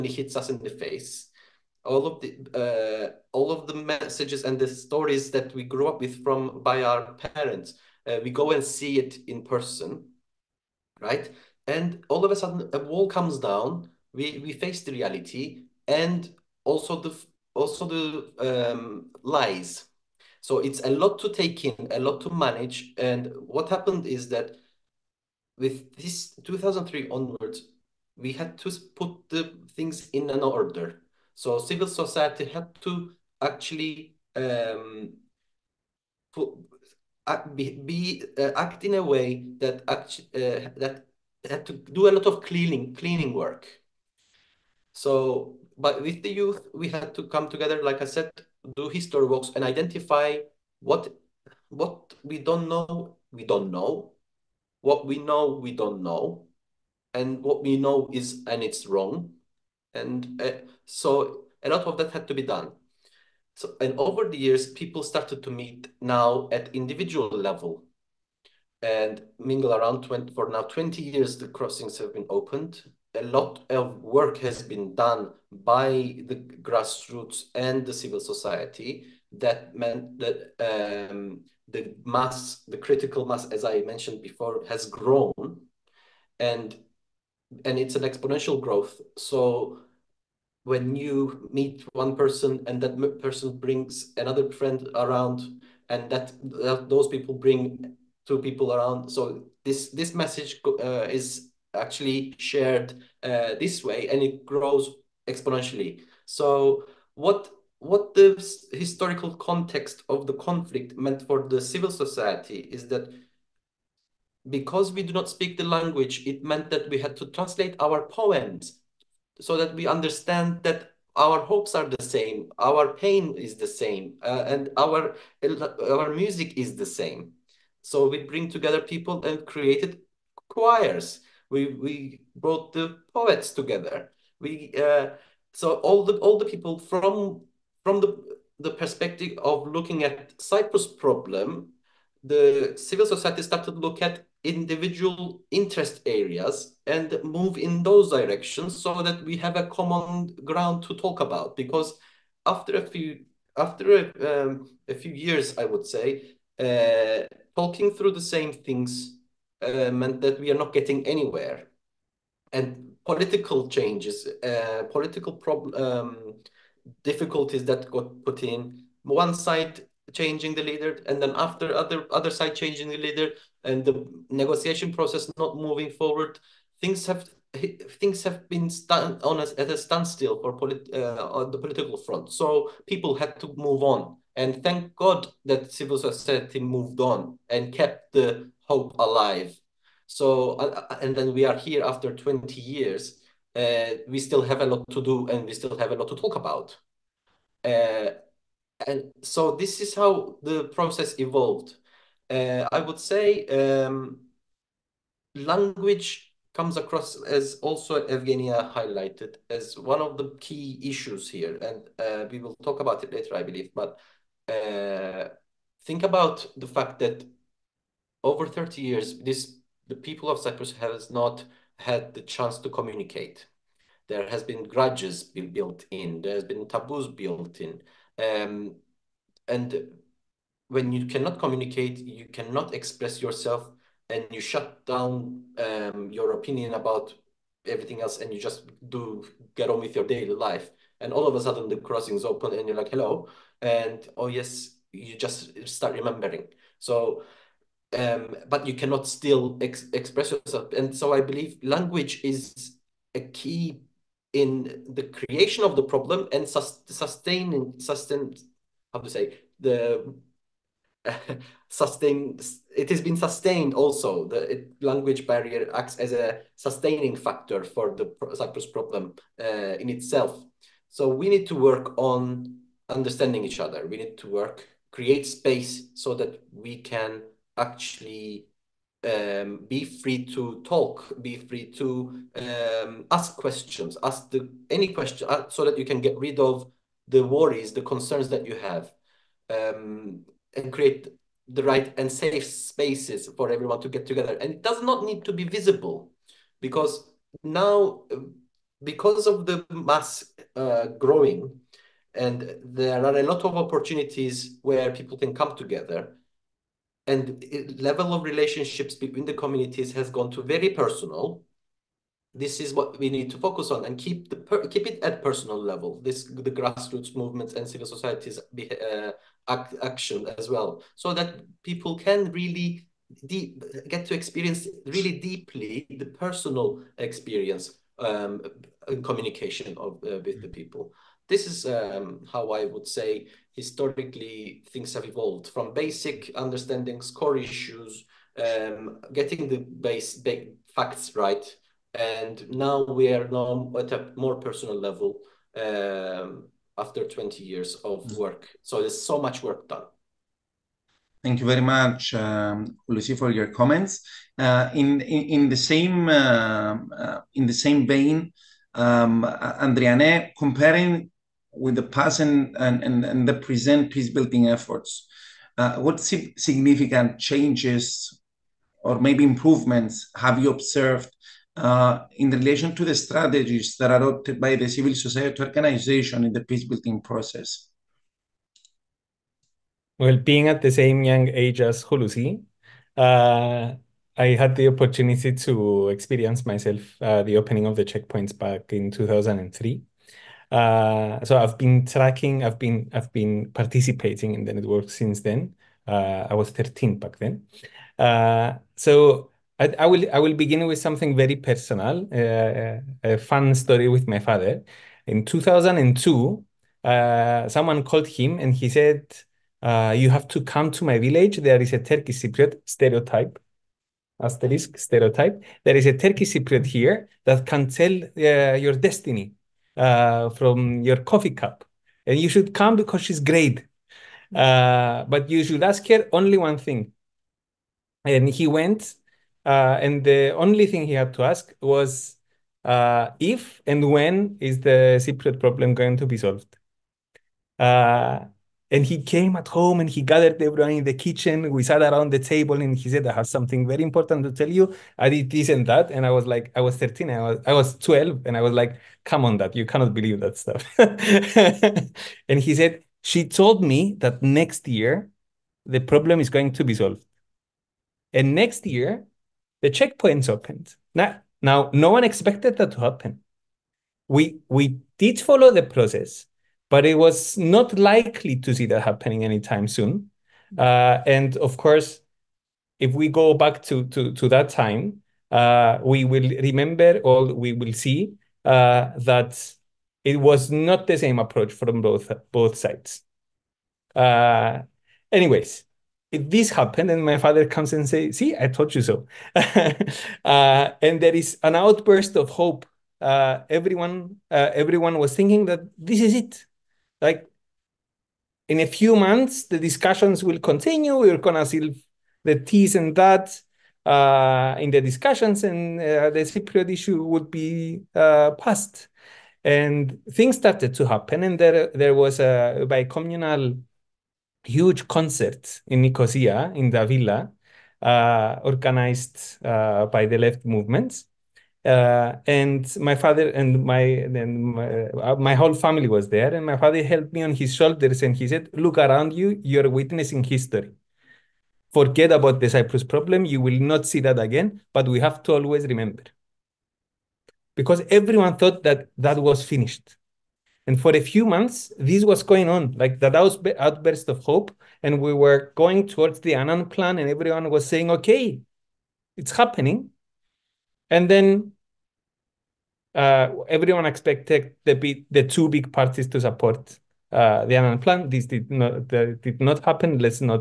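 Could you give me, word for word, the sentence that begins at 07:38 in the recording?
And next year, the checkpoints opened.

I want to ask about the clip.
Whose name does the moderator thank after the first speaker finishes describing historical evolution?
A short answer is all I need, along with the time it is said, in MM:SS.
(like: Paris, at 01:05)
Lucy, at 05:52.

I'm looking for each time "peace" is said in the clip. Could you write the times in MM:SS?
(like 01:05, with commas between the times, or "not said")
06:03, 06:16.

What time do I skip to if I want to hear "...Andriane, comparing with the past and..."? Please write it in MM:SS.
05:59.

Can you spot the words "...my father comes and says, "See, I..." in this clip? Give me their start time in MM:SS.
08:07.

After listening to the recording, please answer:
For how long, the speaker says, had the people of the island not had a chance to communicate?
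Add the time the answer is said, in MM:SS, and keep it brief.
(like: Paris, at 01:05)
thirty years, at 03:38.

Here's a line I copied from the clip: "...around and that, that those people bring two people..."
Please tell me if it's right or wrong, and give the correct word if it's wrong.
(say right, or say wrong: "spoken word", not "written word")
right.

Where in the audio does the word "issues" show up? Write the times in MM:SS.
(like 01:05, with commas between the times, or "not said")
03:30, 05:37, 08:26.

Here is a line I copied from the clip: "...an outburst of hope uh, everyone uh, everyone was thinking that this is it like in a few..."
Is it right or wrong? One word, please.
right.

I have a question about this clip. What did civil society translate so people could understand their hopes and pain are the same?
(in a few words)
poems.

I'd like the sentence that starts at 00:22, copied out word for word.
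And what happened is that with this 2003 onwards, we had to put the things in an order.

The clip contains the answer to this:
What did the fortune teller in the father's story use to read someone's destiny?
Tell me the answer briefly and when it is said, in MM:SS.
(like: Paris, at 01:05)
coffee cup, at 07:01.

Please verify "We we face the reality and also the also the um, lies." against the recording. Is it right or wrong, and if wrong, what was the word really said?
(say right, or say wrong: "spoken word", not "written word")
right.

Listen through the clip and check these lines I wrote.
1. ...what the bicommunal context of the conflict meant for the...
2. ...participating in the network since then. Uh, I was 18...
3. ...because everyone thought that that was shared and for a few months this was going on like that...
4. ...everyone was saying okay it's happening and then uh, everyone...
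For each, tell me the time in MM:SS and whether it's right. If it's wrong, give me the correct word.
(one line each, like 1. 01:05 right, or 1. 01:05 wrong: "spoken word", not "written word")
1. 01:47 wrong: "historical", not "bicommunal"
2. 06:33 wrong: "13", not "18"
3. 08:57 wrong: "finished", not "shared"
4. 09:07 right.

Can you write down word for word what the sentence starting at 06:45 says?
In 2002, uh, someone called him and he said, "You have to come to my village.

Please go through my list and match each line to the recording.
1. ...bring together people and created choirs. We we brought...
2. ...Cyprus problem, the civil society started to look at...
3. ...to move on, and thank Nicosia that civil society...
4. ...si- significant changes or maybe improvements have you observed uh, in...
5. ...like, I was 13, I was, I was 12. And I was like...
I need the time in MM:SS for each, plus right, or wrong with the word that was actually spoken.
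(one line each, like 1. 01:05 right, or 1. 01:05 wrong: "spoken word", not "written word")
1. 02:08 right
2. 02:20 right
3. 03:03 wrong: "God", not "Nicosia"
4. 06:05 right
5. 07:26 right.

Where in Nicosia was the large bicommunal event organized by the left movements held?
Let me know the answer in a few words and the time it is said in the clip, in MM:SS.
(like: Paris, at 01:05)
Davila, at 08:36.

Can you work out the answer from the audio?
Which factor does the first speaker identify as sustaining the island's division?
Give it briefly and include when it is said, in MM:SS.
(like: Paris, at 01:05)
language barrier, at 04:24.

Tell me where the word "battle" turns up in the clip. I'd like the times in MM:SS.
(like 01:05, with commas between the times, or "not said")
not said.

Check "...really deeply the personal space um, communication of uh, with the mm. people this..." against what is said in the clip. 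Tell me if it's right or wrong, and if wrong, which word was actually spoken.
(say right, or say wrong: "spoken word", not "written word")
wrong: "experience", not "space".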